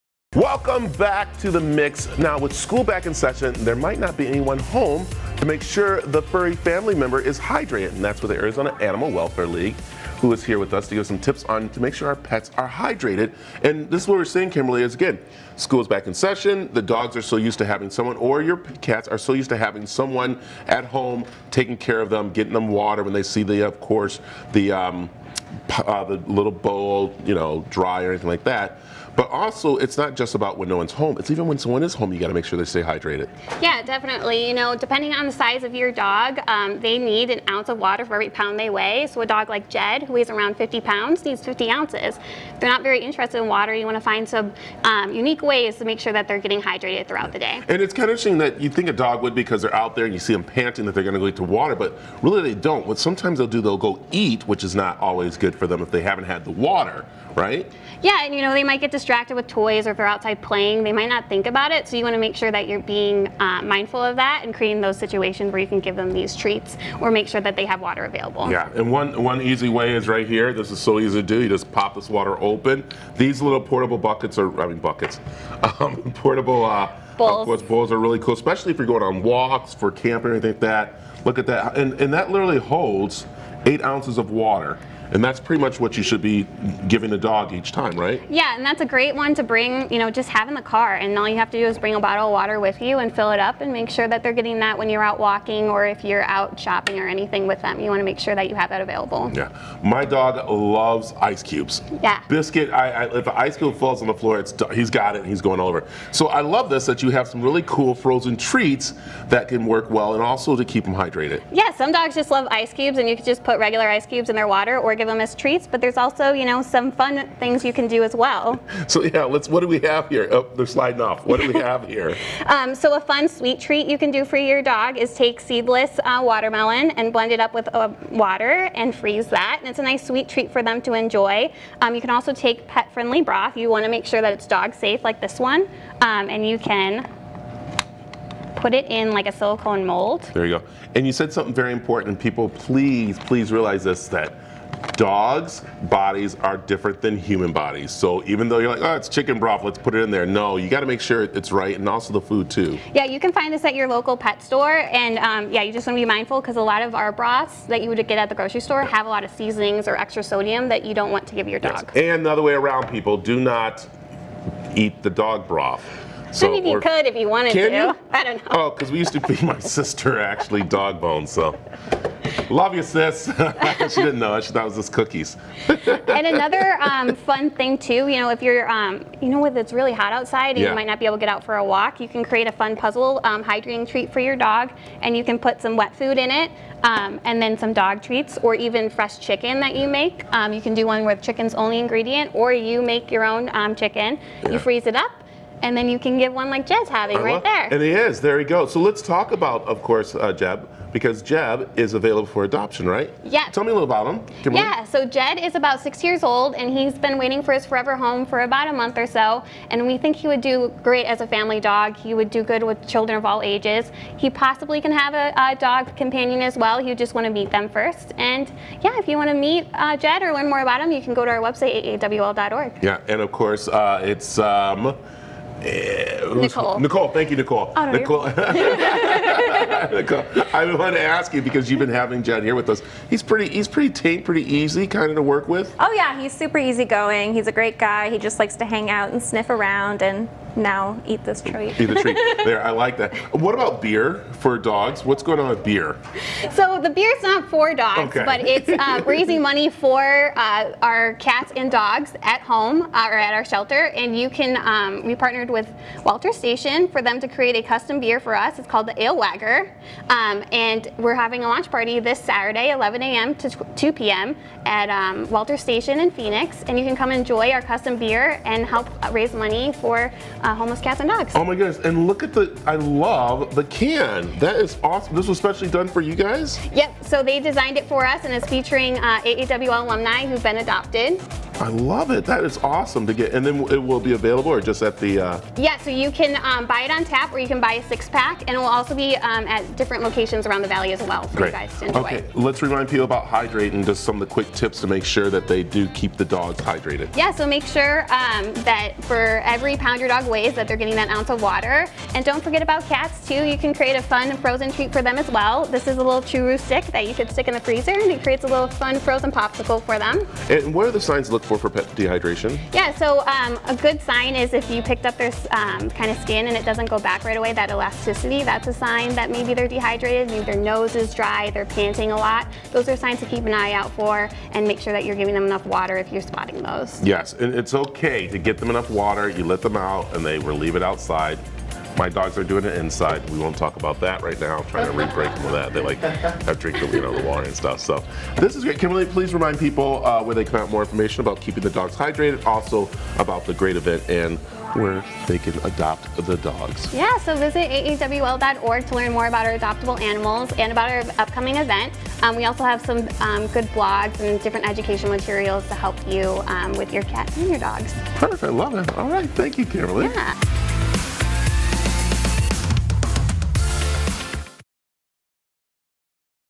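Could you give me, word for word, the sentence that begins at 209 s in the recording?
And we think he would do great as a family dog.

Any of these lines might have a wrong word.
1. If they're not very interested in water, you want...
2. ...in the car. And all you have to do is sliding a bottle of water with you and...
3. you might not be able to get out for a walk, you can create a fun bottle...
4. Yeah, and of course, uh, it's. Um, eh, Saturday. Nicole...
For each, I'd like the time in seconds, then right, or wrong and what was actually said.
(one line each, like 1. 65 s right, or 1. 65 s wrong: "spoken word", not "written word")
1. 42 s right
2. 90 s wrong: "bring", not "sliding"
3. 180 s wrong: "puzzle", not "bottle"
4. 222 s wrong: "Nicole", not "Saturday".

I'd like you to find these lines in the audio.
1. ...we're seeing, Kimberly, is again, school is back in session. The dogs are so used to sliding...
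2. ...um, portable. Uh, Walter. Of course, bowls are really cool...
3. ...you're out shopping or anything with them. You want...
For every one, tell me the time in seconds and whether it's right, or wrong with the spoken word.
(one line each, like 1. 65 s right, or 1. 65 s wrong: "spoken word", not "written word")
1. 14 s wrong: "having", not "sliding"
2. 75 s wrong: "Bowls", not "Walter"
3. 96 s right.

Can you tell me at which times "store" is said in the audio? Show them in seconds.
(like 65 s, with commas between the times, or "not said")
154 s, 158 s.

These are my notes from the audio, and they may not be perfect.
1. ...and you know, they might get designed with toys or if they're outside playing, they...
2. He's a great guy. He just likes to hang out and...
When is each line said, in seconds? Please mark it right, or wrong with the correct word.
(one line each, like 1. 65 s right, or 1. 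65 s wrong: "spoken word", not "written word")
1. 58 s wrong: "distracted", not "designed"
2. 237 s right.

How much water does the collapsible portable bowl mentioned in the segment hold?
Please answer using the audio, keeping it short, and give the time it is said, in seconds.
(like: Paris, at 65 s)
8 ounces, at 83 s.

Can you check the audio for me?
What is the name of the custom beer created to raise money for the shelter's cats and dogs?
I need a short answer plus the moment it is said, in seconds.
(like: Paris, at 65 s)
Ale Wagger, at 259 s.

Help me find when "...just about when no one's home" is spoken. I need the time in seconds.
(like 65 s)
30 s.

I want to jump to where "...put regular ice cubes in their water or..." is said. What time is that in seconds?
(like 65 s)
113 s.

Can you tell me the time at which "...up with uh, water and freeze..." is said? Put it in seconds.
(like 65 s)
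127 s.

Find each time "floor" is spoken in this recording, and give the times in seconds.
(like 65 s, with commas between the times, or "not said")
104 s.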